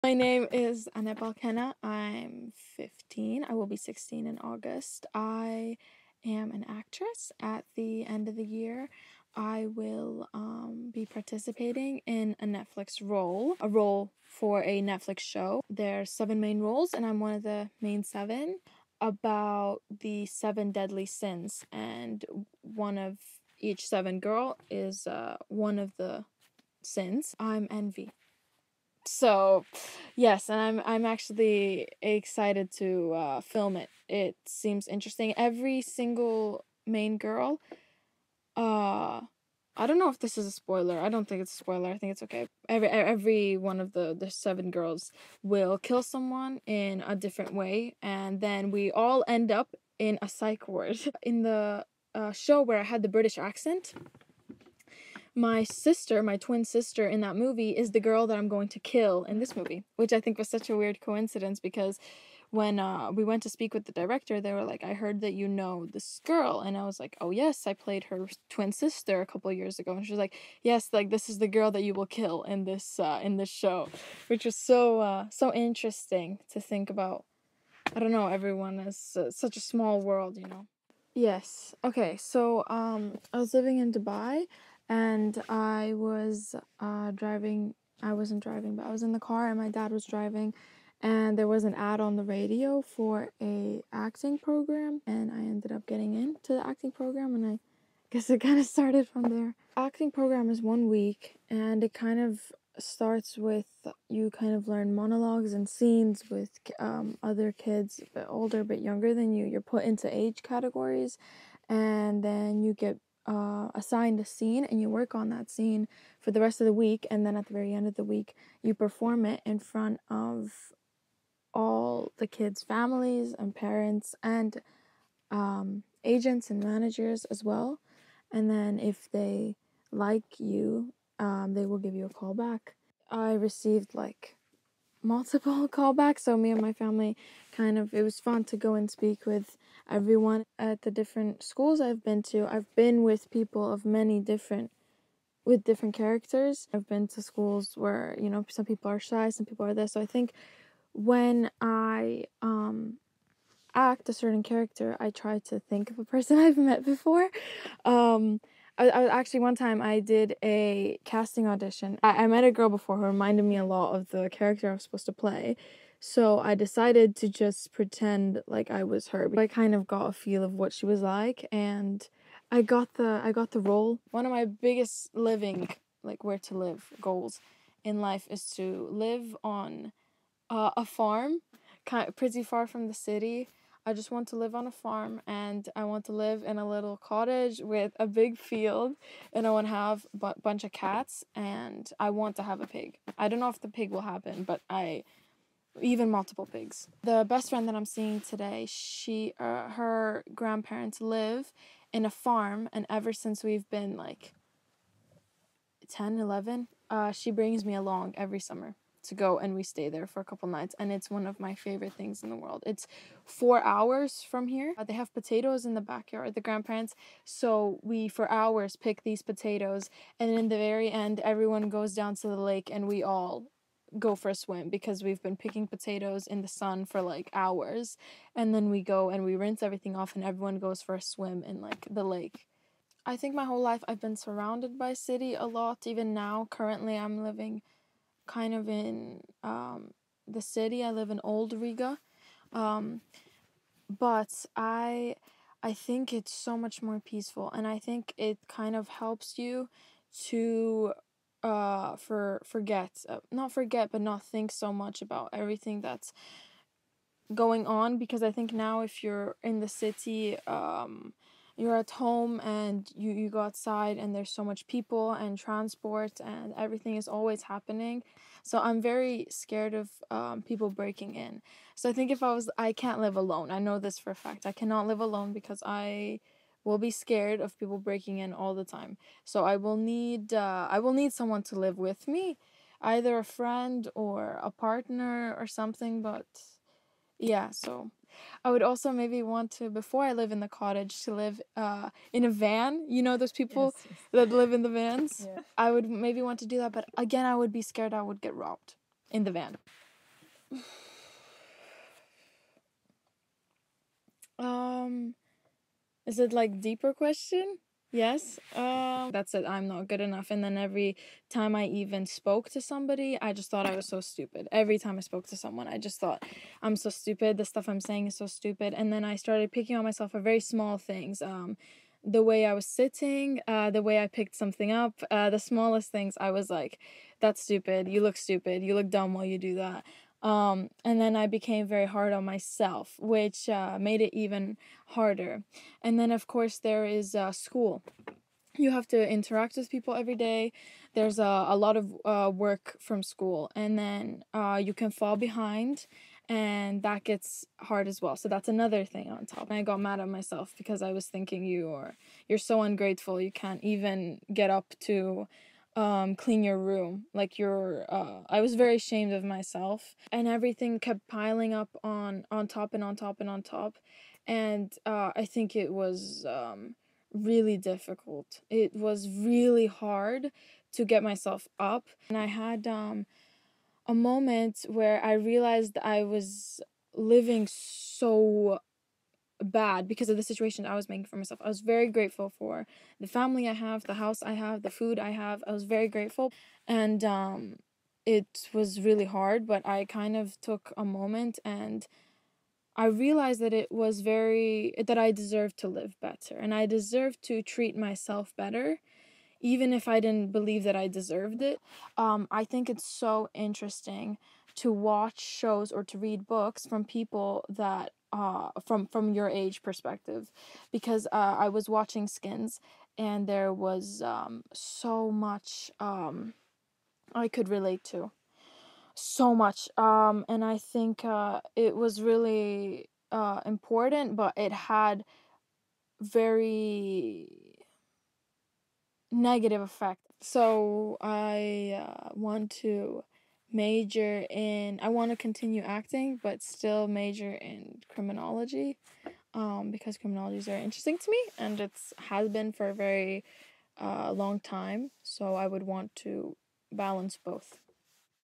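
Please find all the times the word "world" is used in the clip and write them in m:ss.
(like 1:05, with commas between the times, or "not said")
1:20, 3:32.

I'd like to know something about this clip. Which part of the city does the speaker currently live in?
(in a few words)
Old Riga.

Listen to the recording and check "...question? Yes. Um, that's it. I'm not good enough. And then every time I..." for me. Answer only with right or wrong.
right.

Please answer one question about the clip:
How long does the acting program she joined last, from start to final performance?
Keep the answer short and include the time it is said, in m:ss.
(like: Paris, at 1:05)
One week, at 1:40.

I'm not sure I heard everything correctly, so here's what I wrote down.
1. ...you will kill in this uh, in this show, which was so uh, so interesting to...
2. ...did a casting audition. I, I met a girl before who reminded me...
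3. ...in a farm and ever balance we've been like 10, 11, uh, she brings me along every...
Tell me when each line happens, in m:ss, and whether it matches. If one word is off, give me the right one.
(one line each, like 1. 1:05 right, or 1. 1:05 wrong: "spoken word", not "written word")
1. 1:11 right
2. 2:39 right
3. 3:21 wrong: "since", not "balance".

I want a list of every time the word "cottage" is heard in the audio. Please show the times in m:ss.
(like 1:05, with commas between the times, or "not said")
3:06, 4:50.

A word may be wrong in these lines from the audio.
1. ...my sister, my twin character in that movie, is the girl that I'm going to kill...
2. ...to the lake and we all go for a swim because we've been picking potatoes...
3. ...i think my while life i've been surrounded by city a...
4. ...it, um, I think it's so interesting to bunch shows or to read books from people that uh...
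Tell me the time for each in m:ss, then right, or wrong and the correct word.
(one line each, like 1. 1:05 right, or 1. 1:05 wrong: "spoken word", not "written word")
1. 0:55 wrong: "sister", not "character"
2. 3:42 right
3. 3:53 wrong: "whole", not "while"
4. 6:41 wrong: "watch", not "bunch".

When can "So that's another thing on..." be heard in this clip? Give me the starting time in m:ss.
5:48.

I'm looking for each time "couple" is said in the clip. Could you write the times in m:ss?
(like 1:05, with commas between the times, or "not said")
1:09, 3:30.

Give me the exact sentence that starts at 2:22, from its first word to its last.
I've been with people of many different with different characters.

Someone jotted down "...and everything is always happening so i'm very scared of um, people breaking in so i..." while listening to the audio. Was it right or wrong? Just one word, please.
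right.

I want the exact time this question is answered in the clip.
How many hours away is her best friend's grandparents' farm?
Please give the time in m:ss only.
3:33.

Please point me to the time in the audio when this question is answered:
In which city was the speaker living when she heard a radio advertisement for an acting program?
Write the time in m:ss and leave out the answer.
1:23.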